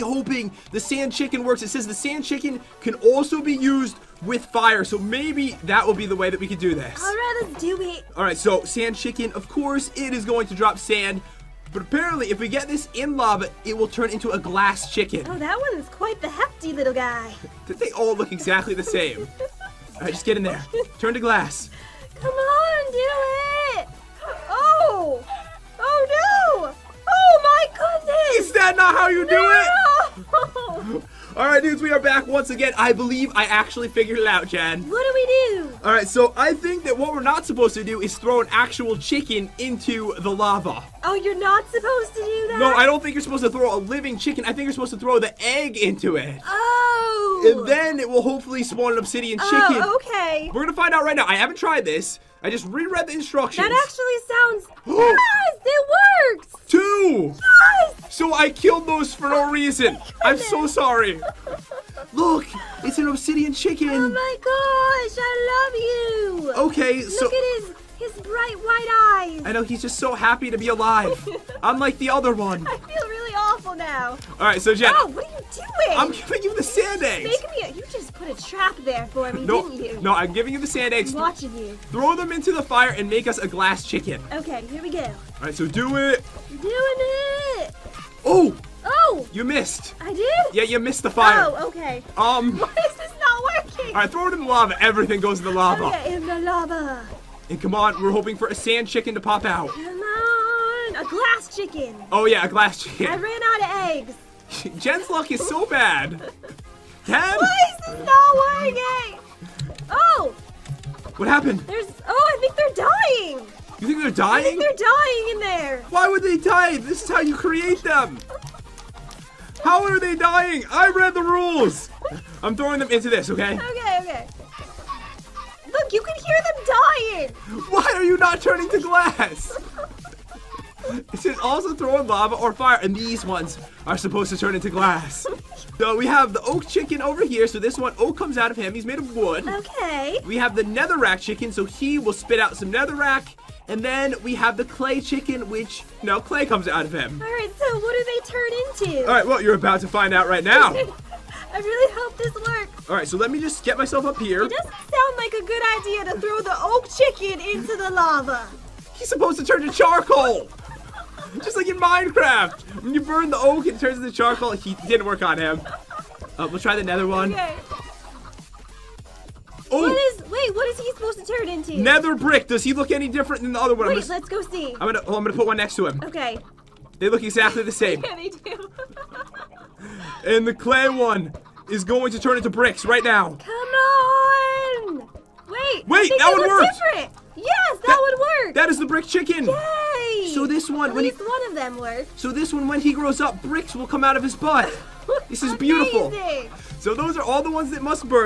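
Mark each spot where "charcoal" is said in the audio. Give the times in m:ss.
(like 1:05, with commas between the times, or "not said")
2:39, 2:44.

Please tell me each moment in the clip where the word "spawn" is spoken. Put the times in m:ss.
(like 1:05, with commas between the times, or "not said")
0:48.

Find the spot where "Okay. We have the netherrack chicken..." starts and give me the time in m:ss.
2:19.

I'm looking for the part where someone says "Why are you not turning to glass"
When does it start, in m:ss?
2:07.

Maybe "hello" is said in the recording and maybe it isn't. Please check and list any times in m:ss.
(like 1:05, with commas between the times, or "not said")
not said.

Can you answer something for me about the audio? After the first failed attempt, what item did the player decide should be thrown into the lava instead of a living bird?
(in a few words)
The egg.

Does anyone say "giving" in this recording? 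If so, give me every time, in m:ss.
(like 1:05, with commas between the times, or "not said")
1:16, 1:20.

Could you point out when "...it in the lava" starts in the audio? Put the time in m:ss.
1:34.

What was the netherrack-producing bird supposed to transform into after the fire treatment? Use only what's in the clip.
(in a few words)
Nether brick.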